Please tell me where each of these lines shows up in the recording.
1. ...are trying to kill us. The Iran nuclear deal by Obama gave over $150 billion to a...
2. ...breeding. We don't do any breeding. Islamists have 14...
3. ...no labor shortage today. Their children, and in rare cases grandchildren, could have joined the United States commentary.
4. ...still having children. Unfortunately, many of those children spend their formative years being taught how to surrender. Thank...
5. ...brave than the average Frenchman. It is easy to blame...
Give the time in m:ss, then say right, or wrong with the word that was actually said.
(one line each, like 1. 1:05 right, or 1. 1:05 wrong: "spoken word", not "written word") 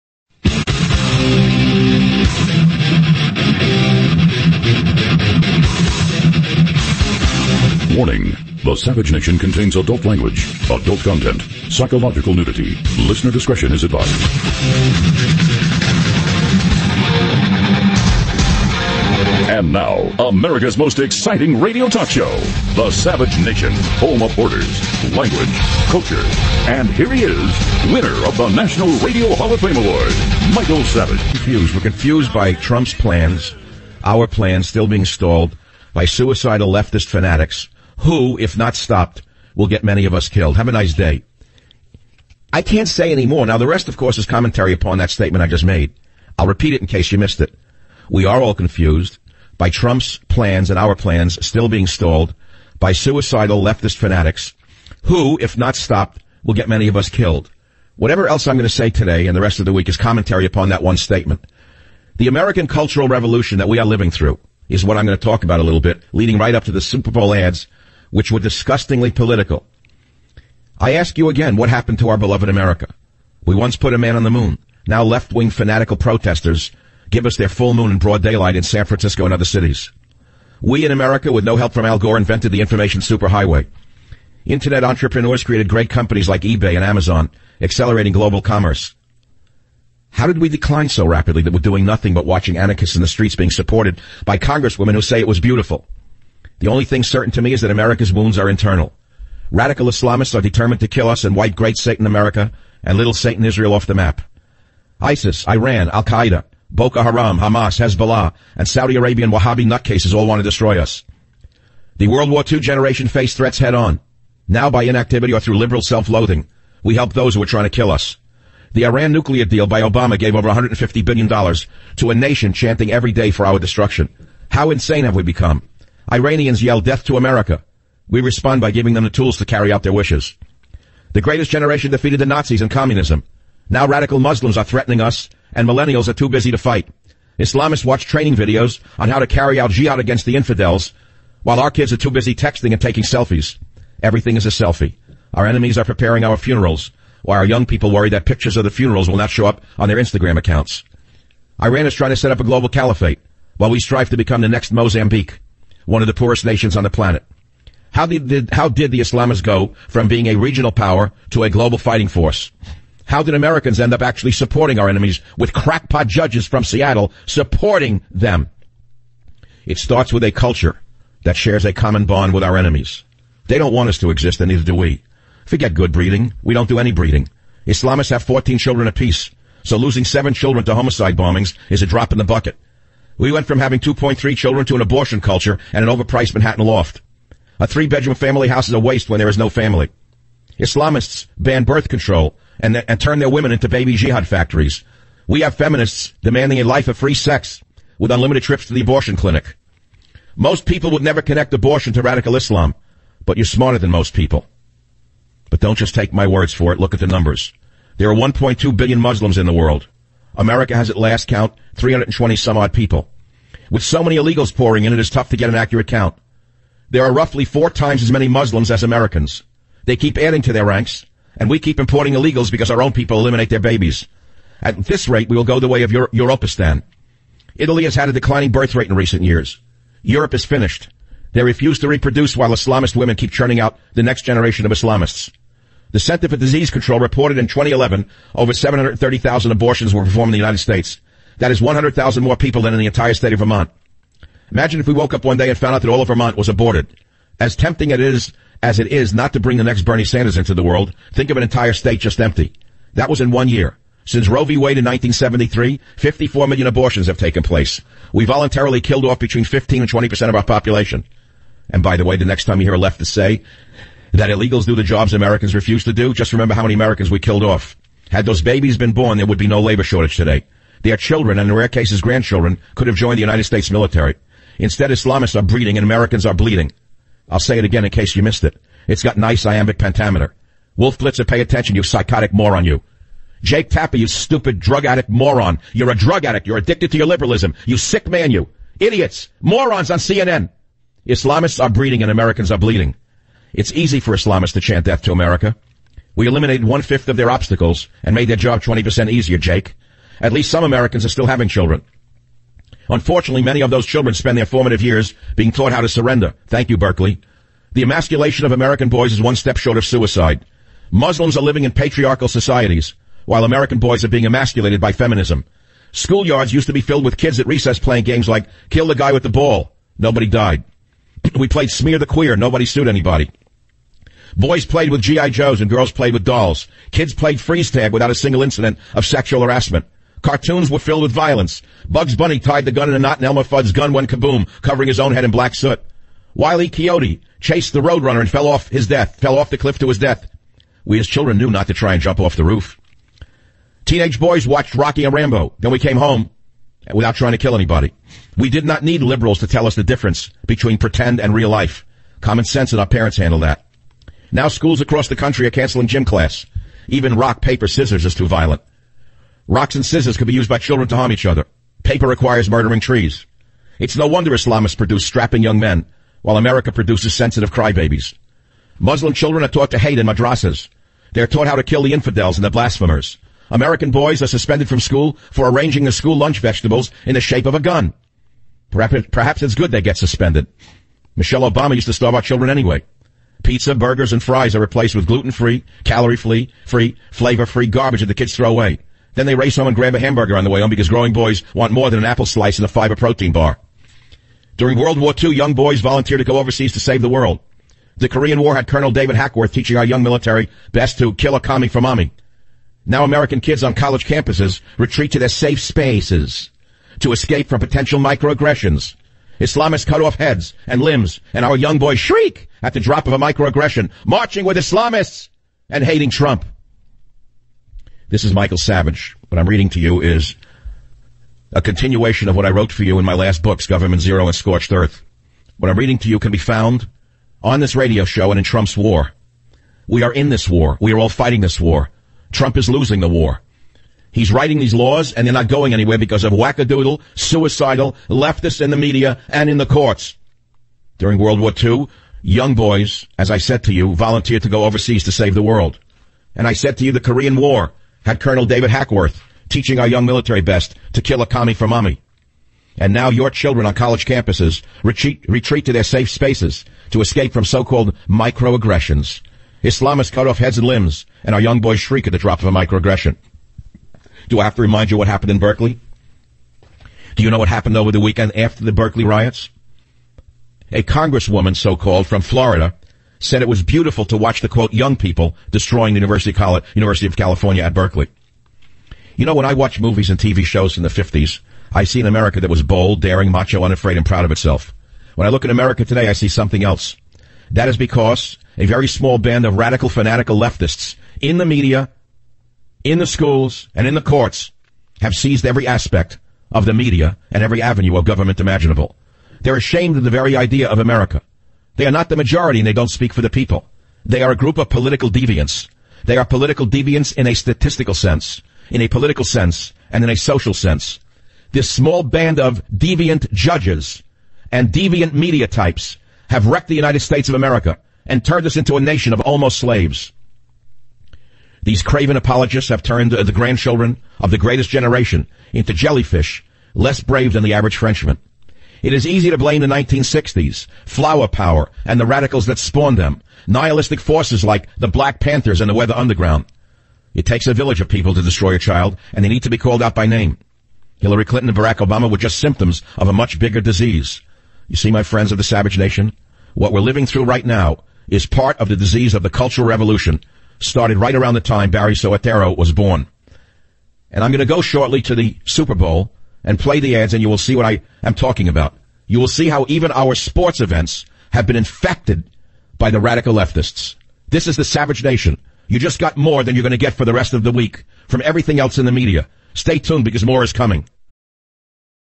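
1. 1:57 right
2. 2:55 right
3. 4:29 wrong: "military", not "commentary"
4. 5:01 right
5. 8:47 right.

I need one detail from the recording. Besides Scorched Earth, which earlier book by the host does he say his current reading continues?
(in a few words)
Government Zero.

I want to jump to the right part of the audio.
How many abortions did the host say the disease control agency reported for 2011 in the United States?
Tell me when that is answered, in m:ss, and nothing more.
3:58.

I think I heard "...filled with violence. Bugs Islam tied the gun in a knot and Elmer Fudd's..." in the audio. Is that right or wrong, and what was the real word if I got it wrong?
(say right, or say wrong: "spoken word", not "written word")
wrong: "Bunny", not "Islam".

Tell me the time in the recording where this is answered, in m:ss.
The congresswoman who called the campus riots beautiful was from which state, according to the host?
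7:52.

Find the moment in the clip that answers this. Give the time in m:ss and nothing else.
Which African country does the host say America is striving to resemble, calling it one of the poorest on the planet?
2:34.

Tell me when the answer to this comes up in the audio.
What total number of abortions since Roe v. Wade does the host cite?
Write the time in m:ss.
4:15.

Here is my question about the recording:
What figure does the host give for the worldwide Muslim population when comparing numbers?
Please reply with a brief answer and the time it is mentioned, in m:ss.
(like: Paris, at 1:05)
1.2 billion, at 3:28.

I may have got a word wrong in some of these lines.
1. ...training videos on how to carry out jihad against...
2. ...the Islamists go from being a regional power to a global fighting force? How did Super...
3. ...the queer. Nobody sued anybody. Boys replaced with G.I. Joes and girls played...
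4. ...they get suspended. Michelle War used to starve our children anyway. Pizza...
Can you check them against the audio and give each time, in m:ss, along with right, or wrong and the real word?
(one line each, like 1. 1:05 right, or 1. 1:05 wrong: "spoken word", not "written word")
1. 2:18 right
2. 2:38 wrong: "Americans", not "Super"
3. 5:21 wrong: "played", not "replaced"
4. 6:19 wrong: "Obama", not "War".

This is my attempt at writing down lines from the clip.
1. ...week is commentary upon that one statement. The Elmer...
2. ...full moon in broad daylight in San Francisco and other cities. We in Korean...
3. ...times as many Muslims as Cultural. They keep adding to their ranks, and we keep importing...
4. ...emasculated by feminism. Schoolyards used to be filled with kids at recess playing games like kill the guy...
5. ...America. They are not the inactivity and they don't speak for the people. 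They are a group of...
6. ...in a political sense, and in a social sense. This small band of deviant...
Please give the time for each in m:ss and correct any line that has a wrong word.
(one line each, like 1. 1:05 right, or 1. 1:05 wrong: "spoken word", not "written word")
1. 0:59 wrong: "American", not "Elmer"
2. 1:17 wrong: "America", not "Korean"
3. 3:37 wrong: "Americans", not "Cultural"
4. 5:14 right
5. 8:20 wrong: "majority", not "inactivity"
6. 8:28 right.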